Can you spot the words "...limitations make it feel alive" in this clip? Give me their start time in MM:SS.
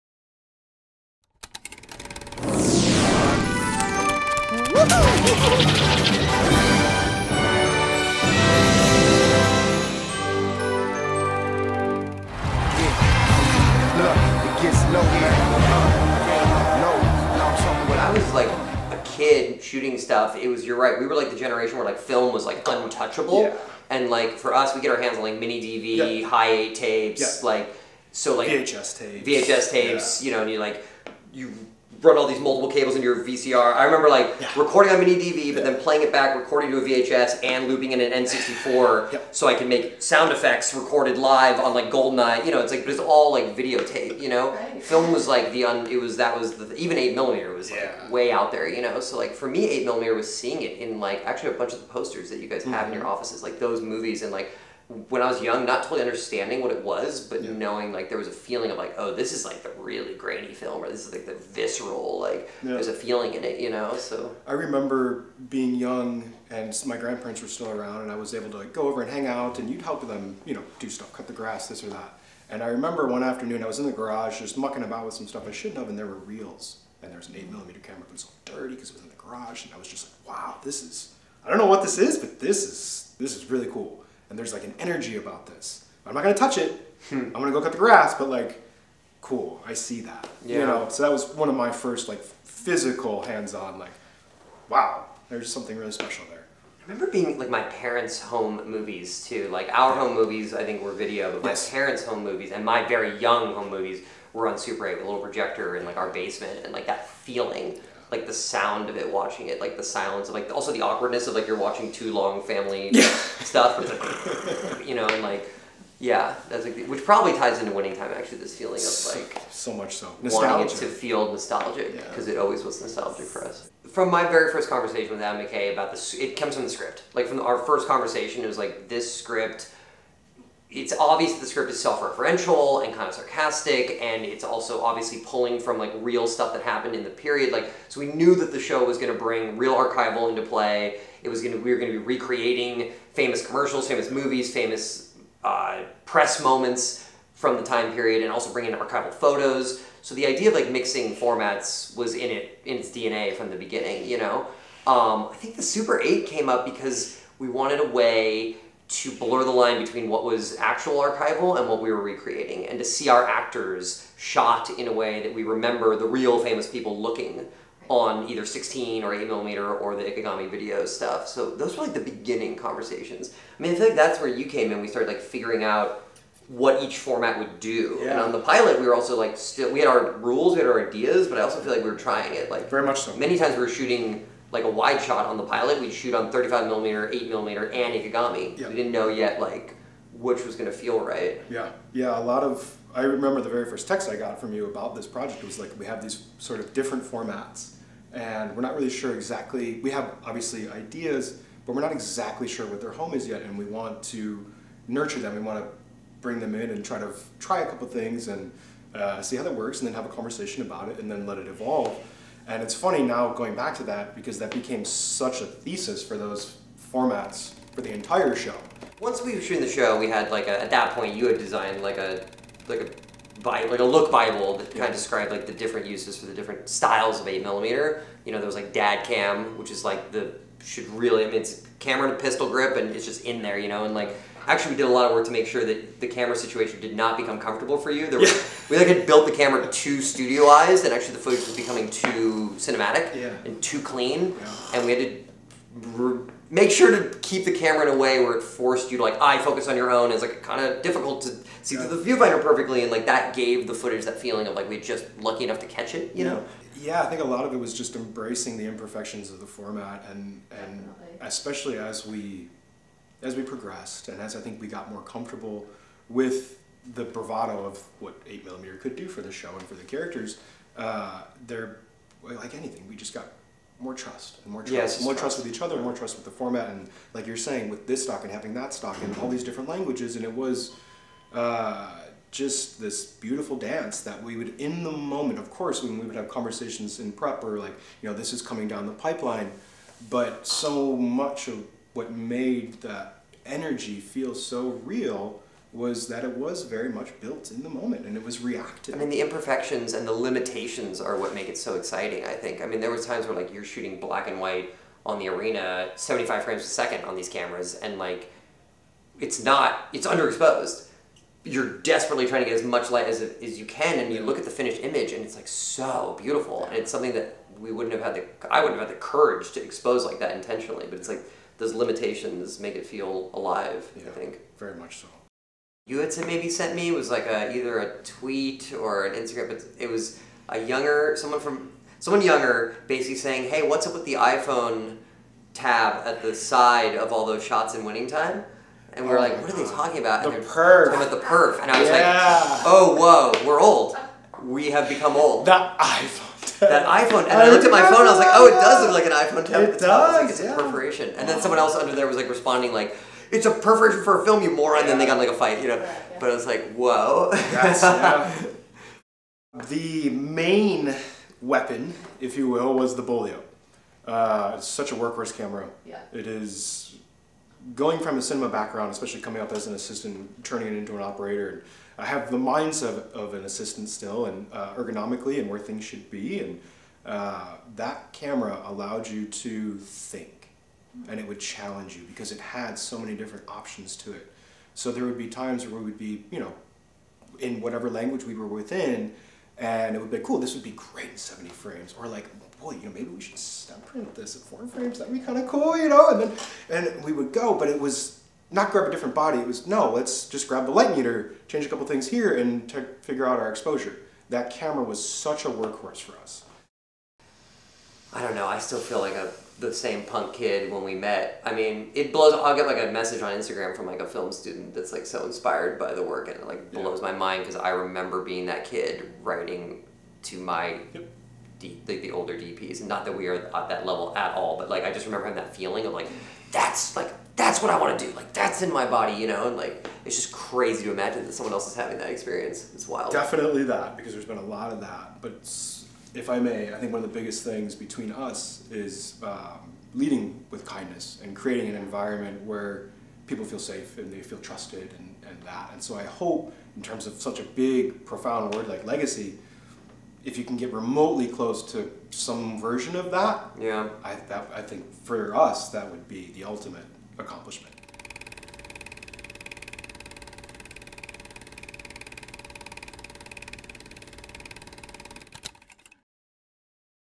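05:21.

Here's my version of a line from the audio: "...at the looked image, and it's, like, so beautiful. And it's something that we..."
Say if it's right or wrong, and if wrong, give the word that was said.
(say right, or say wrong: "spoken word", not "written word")
wrong: "finished", not "looked".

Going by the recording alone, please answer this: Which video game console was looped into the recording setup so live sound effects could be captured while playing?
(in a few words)
N64.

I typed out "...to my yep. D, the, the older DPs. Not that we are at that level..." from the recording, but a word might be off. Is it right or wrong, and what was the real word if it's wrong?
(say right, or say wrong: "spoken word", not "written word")
right.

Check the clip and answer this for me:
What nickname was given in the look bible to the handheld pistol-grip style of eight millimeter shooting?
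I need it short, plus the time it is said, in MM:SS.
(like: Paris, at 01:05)
dad cam, at 03:48.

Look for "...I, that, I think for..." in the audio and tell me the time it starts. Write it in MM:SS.
07:34.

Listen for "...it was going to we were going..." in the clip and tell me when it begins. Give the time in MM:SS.
02:21.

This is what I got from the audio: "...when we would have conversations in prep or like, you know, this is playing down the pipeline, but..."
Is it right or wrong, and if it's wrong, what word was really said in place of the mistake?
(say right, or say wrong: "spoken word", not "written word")
wrong: "coming", not "playing".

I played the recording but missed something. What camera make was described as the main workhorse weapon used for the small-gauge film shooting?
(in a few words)
Beaulieu.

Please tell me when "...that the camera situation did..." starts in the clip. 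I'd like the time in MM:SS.
03:55.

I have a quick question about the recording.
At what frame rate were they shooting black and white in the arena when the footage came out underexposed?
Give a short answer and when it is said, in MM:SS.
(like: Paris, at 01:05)
75 frames per second, at 05:05.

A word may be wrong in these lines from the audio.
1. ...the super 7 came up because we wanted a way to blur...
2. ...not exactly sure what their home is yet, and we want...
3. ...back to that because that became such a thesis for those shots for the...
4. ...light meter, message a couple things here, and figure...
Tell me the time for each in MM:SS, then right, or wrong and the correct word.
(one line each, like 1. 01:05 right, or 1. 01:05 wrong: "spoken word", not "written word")
1. 02:35 wrong: "8", not "7"
2. 03:21 right
3. 03:33 wrong: "formats", not "shots"
4. 06:40 wrong: "change", not "message".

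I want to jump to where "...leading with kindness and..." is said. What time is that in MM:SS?
07:19.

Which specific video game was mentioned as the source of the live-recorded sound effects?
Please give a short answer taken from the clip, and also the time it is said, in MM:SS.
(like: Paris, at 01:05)
GoldenEye, at 00:41.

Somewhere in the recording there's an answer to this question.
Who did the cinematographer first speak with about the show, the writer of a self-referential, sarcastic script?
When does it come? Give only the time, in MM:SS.
02:05.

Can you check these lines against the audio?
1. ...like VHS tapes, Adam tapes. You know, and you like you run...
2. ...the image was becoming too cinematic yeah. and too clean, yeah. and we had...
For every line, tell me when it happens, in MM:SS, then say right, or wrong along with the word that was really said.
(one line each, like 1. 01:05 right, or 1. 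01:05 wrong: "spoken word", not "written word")
1. 00:28 wrong: "VHS", not "Adam"
2. 04:01 wrong: "footage", not "image".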